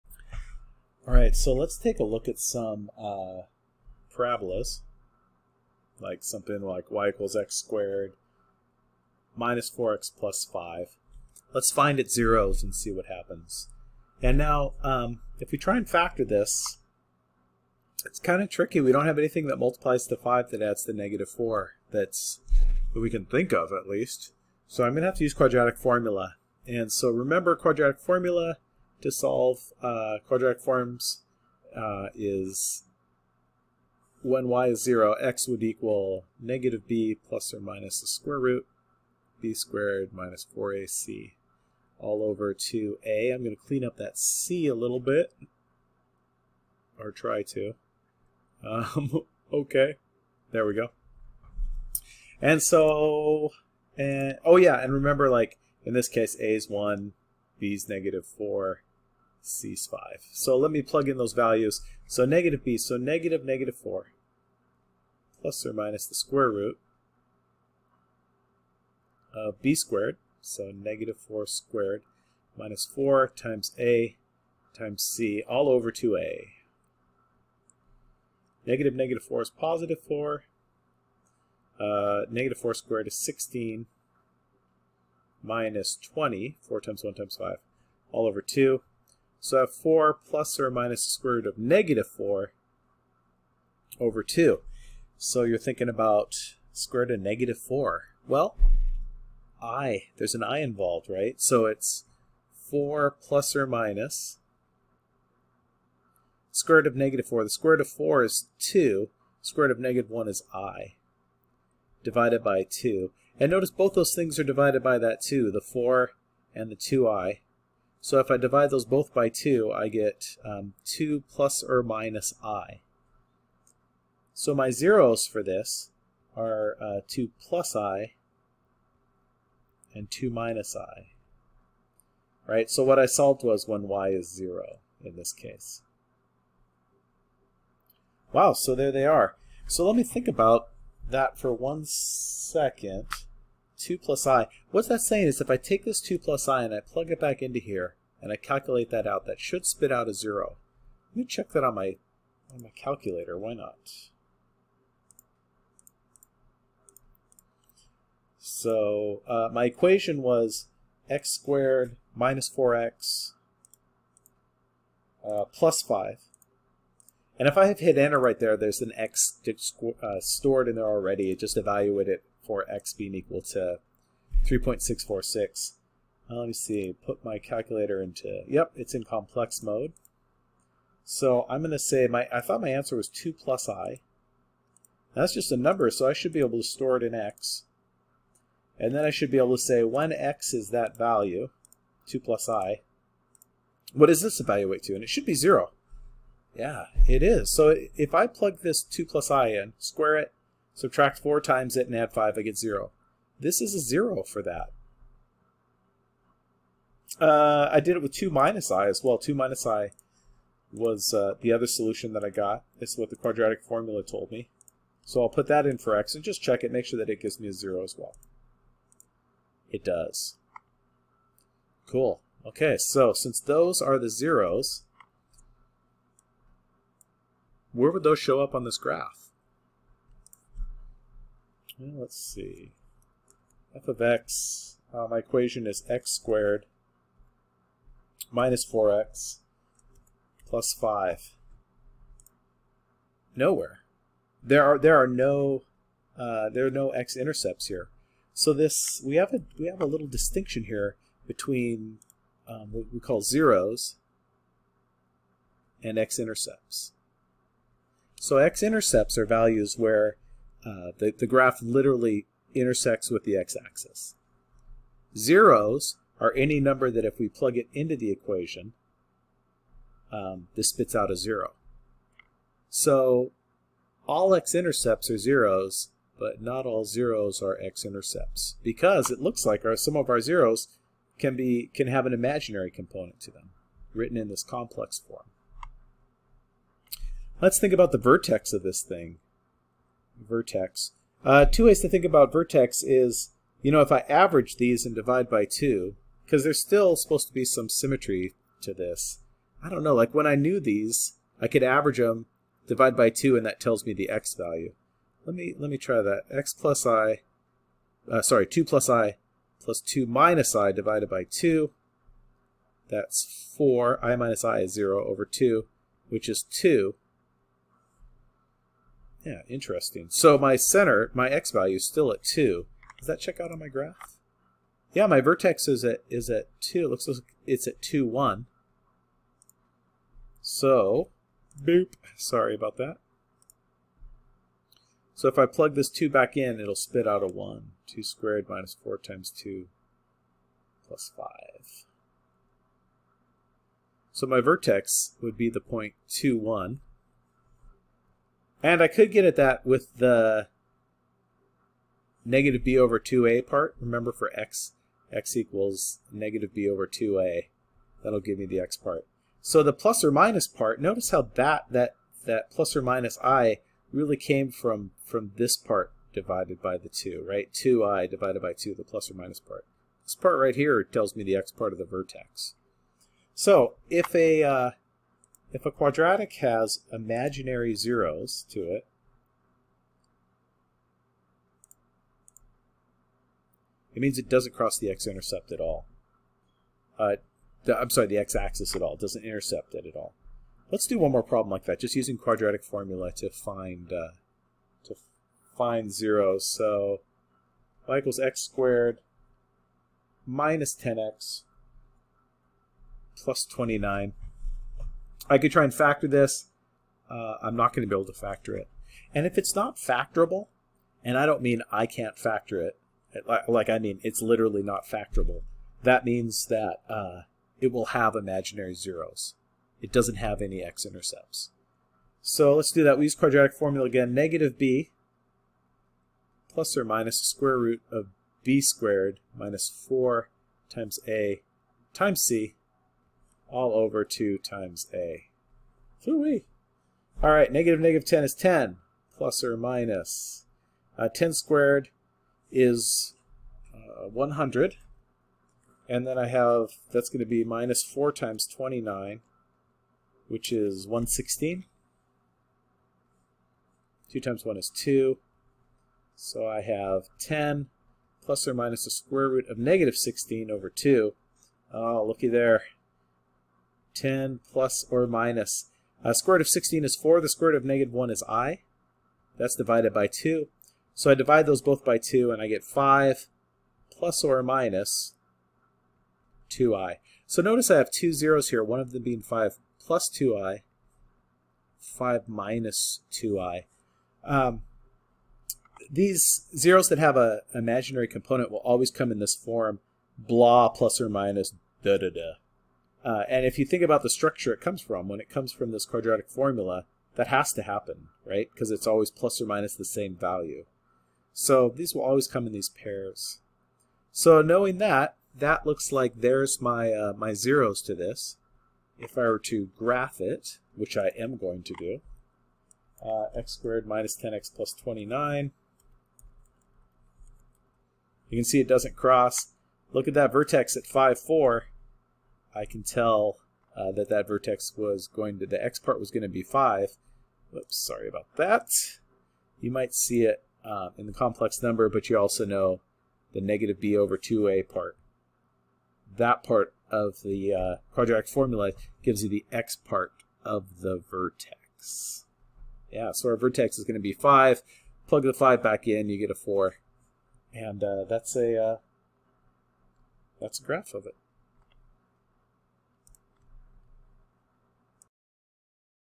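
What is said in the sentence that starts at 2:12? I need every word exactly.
Right, so what I solved was when y is 0 in this case.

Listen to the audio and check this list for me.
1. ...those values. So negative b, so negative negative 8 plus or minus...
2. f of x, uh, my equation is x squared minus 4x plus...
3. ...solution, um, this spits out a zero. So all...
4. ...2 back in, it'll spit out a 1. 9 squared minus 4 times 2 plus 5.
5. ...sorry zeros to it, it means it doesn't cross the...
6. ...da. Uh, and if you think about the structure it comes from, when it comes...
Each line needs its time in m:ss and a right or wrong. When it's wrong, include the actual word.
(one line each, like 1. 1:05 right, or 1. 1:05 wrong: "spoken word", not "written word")
1. 1:01 wrong: "4", not "8"
2. 3:53 right
3. 4:28 wrong: "equation", not "solution"
4. 5:35 wrong: "2", not "9"
5. 6:16 wrong: "imaginary", not "sorry"
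6. 8:12 right.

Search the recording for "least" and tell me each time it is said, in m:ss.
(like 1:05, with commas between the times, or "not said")
0:23.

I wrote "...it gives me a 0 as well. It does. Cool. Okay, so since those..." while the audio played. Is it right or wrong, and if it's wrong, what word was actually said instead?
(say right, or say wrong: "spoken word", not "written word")
right.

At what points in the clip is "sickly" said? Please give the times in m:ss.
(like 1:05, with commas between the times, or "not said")
not said.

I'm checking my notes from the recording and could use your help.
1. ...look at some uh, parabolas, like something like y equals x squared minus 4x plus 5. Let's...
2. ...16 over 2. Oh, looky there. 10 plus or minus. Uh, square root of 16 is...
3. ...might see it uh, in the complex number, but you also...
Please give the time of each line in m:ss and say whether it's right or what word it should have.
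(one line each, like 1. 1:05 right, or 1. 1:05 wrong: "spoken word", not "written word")
1. 0:02 right
2. 7:39 right
3. 8:49 right.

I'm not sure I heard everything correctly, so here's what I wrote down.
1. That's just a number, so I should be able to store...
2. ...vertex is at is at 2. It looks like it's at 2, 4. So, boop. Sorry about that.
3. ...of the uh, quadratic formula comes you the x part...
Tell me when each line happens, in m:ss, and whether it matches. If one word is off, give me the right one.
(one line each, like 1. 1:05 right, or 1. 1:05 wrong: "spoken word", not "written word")
1. 3:05 right
2. 5:25 wrong: "1", not "4"
3. 8:56 wrong: "gives", not "comes".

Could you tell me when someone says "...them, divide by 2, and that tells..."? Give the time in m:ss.
5:01.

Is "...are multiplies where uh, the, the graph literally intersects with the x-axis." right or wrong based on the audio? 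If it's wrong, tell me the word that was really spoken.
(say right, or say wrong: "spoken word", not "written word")
wrong: "values", not "multiplies".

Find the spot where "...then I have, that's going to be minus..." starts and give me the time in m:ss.
7:26.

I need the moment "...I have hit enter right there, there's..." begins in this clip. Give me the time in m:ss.
2:47.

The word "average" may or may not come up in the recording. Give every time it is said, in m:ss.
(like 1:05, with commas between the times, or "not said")
4:54, 5:01.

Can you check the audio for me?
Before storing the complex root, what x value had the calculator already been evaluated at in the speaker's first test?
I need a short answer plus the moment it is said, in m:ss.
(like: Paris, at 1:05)
3.646, at 2:54.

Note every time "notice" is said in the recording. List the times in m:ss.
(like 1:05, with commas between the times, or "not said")
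1:53, 6:00, 7:57.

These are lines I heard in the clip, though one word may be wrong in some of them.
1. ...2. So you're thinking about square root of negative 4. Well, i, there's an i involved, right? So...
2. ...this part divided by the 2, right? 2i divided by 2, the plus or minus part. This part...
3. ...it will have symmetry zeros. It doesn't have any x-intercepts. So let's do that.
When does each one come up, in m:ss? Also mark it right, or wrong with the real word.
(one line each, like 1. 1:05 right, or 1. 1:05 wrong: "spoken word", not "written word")
1. 1:34 right
2. 6:05 right
3. 6:57 wrong: "imaginary", not "symmetry".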